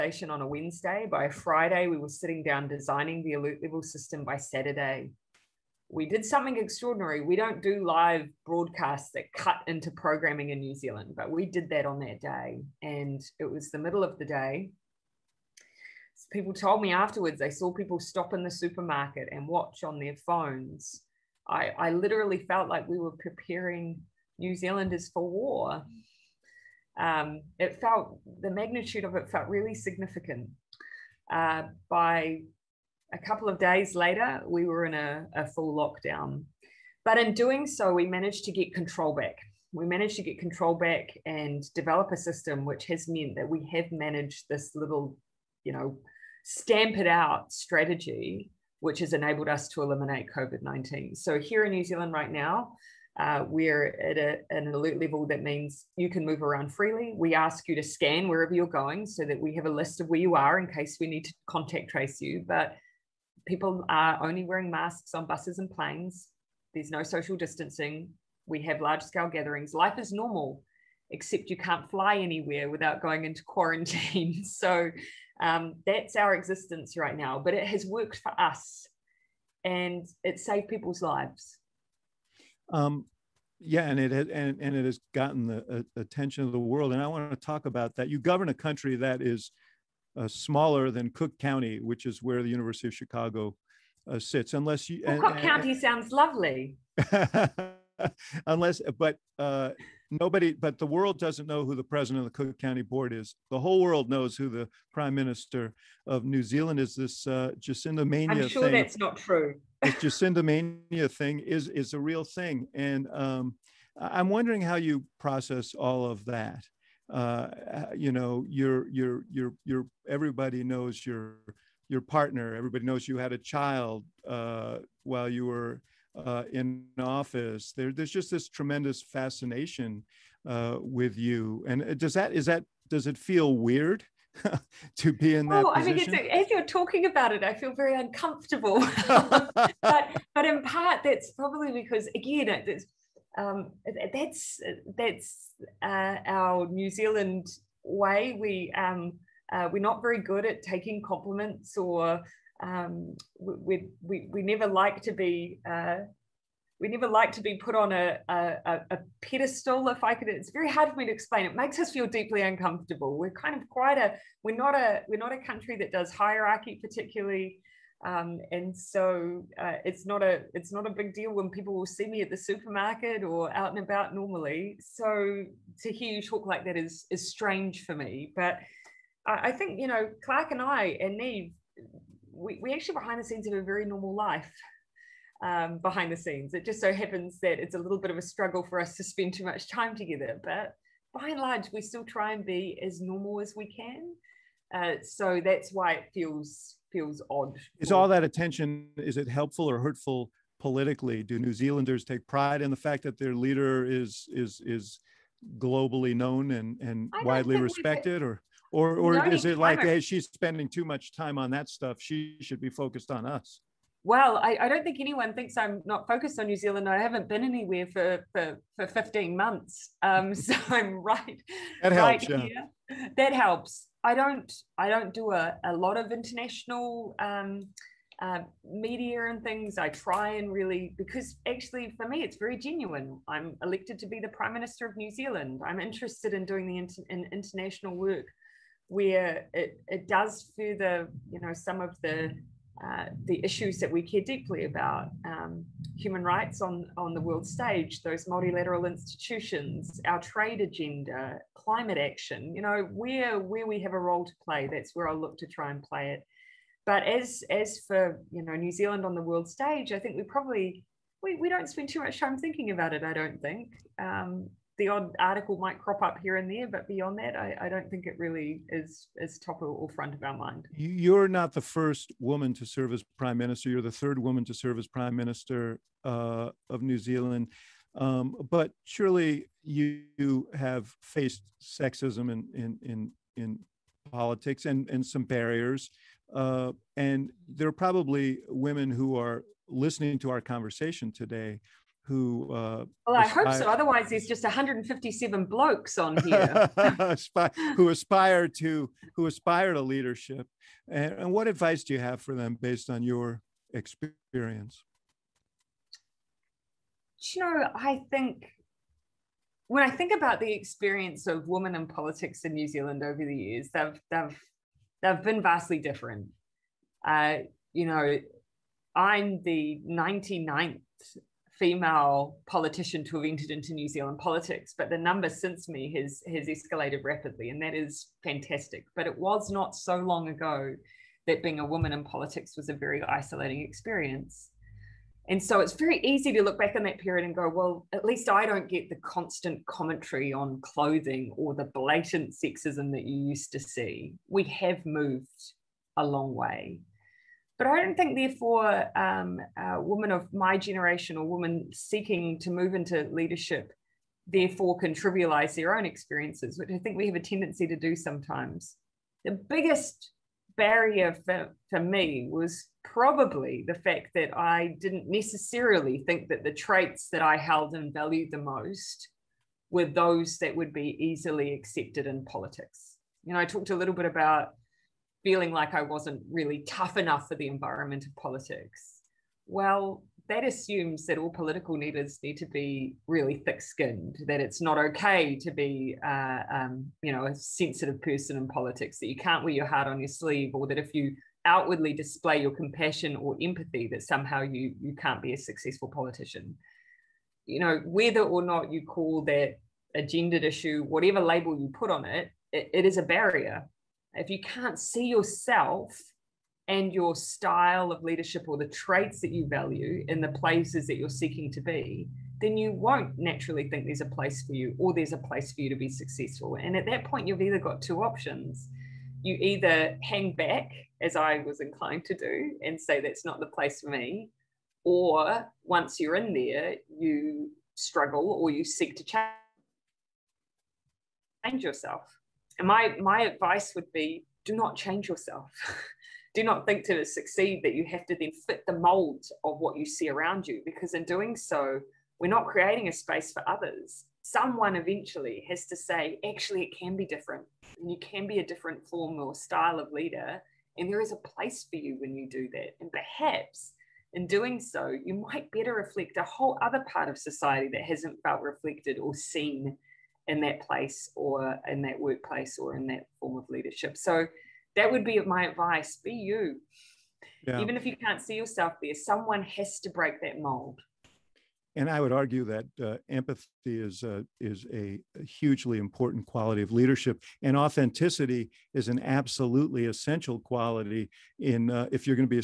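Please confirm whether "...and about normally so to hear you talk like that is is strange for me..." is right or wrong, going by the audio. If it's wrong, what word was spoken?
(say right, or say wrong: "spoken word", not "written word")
right.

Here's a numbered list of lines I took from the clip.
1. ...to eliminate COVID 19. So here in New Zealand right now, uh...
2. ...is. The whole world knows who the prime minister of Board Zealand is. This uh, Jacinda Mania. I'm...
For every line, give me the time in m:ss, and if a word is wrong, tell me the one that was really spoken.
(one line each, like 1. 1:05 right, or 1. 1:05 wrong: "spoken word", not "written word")
1. 0:49 right
2. 1:43 wrong: "New", not "Board".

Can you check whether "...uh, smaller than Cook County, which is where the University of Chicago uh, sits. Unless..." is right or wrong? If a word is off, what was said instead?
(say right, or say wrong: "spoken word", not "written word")
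right.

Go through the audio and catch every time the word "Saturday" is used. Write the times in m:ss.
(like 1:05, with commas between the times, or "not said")
0:04.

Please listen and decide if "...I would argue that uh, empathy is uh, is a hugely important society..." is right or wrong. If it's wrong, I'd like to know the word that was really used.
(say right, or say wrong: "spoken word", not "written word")
wrong: "quality", not "society".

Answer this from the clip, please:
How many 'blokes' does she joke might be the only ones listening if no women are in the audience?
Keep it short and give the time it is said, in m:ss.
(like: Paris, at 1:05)
157, at 4:54.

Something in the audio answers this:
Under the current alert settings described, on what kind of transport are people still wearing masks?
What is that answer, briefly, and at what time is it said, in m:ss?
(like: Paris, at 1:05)
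Buses, at 1:05.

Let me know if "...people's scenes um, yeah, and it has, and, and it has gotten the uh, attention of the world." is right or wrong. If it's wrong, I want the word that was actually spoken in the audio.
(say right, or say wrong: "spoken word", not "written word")
wrong: "lives", not "scenes".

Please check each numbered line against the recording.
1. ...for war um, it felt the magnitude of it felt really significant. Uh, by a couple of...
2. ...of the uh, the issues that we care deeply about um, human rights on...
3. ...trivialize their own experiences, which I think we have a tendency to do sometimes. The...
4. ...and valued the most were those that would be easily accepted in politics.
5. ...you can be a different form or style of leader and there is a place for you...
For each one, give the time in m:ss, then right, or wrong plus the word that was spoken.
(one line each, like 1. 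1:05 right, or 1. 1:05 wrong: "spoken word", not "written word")
1. 0:25 right
2. 4:01 right
3. 5:54 right
4. 6:07 right
5. 7:27 right.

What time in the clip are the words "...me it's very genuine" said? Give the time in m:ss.
3:52.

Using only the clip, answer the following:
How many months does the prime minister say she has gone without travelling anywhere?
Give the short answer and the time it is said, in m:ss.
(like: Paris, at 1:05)
15, at 3:38.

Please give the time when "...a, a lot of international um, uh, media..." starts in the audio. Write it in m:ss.
3:45.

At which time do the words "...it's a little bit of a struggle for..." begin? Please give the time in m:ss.
3:07.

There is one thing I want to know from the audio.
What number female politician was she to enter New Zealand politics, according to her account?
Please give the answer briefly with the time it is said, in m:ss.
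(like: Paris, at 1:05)
99th, at 5:19.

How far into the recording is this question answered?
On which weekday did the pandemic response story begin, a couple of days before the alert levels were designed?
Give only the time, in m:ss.
0:00.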